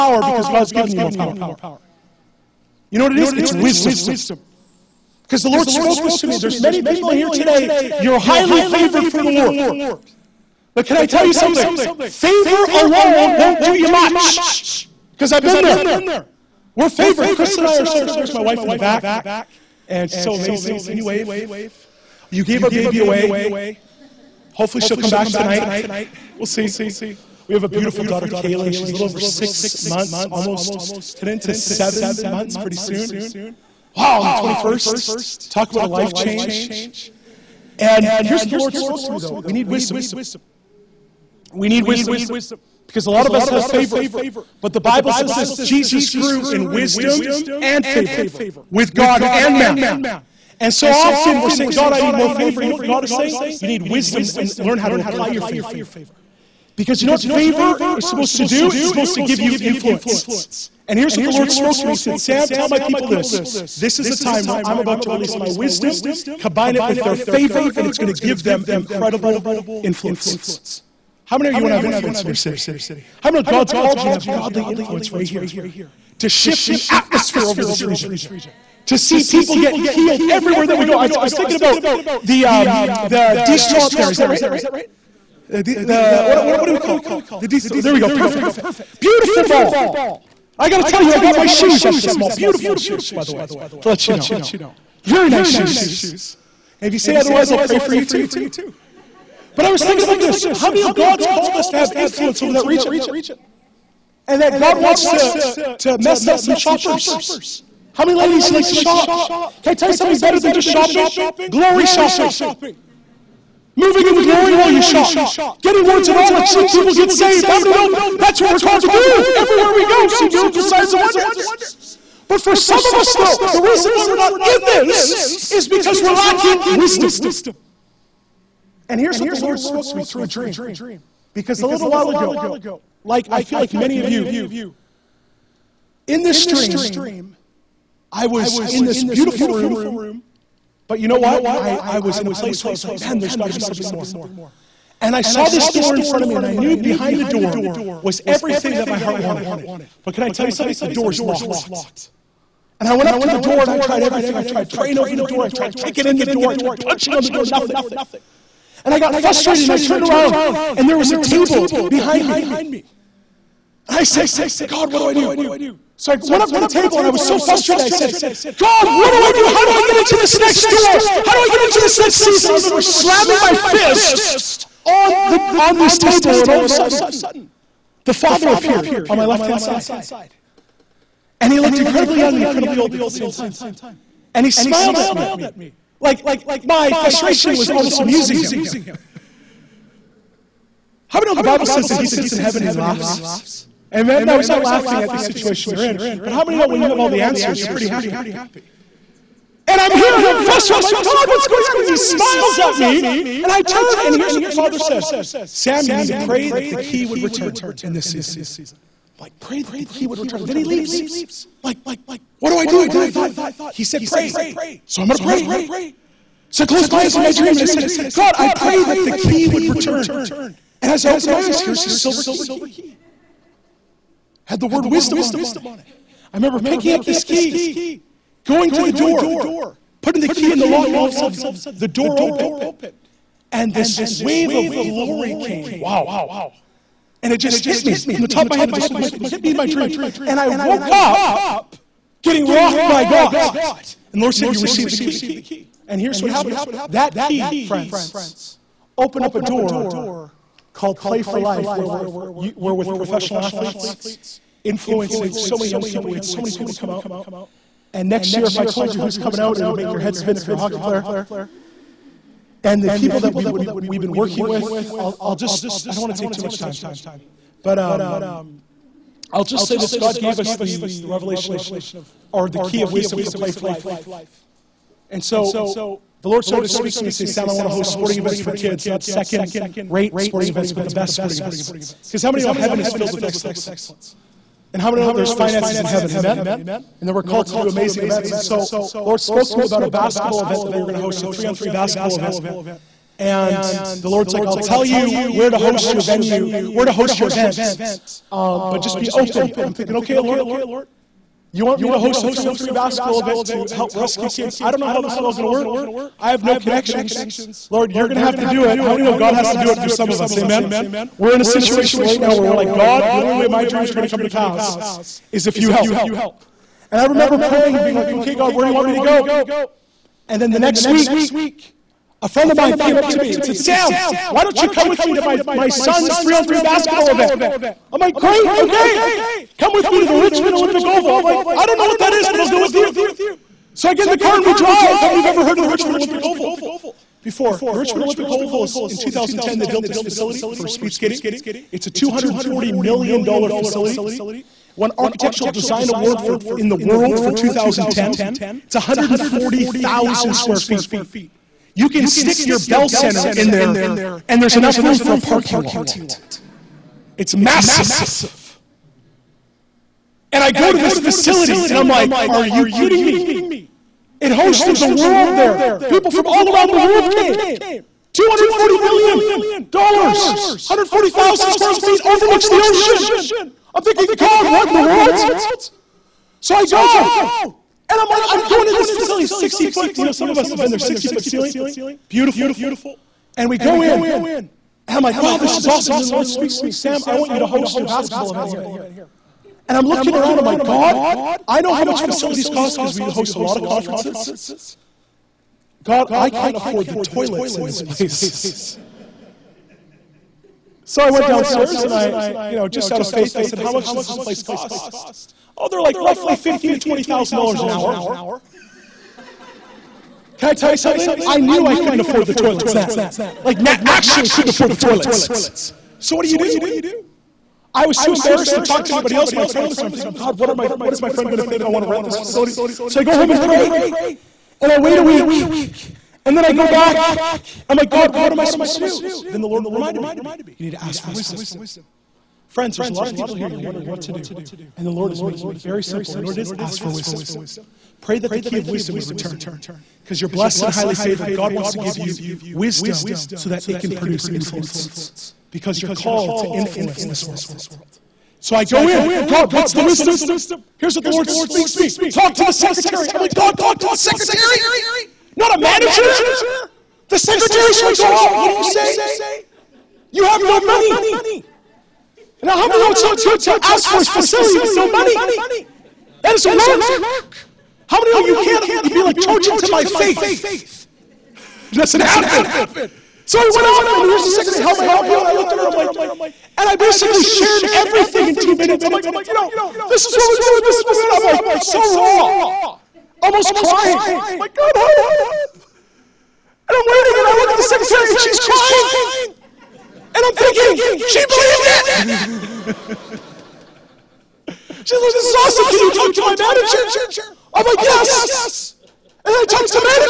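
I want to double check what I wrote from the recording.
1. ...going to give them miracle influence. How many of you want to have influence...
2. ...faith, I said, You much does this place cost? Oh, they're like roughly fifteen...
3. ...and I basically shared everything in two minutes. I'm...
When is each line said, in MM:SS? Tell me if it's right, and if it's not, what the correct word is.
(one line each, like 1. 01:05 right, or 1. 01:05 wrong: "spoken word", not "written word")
1. 01:07 wrong: "incredible", not "miracle"
2. 06:43 wrong: "How", not "You"
3. 07:56 right.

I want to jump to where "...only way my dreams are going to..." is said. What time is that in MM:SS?
05:13.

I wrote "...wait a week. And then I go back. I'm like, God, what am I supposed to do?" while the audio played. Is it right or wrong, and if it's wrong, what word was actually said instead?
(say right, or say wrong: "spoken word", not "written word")
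right.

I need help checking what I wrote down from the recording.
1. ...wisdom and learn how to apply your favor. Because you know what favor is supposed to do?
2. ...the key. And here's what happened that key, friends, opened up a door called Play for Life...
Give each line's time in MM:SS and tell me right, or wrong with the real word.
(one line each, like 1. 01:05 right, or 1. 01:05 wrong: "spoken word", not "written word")
1. 00:53 right
2. 04:04 right.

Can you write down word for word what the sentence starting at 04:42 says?
Because how many know heaven is filled with excellence?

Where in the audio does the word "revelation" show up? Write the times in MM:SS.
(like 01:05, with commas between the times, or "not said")
04:31.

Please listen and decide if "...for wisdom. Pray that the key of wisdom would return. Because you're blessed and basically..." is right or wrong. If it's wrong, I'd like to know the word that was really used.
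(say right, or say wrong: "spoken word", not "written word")
wrong: "highly", not "basically".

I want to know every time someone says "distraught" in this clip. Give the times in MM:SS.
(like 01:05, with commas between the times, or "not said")
01:23, 01:27.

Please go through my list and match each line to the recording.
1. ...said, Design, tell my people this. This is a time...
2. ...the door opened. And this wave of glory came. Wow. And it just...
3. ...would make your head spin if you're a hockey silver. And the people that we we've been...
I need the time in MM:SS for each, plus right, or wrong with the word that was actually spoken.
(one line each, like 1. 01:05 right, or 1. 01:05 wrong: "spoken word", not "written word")
1. 01:01 wrong: "Sam", not "Design"
2. 03:51 right
3. 04:19 wrong: "player", not "silver".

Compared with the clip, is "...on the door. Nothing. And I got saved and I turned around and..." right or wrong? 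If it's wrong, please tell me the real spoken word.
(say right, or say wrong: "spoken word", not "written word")
wrong: "frustrated", not "saved".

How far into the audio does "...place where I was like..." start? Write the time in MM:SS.
02:22.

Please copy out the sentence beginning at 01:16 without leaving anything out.
To shift the atmosphere over this region?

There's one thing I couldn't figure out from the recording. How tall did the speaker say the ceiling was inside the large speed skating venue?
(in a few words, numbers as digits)
60 feet.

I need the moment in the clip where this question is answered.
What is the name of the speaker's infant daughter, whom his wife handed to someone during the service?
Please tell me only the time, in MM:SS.
00:28.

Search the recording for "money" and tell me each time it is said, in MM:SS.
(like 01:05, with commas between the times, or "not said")
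07:40, 07:44.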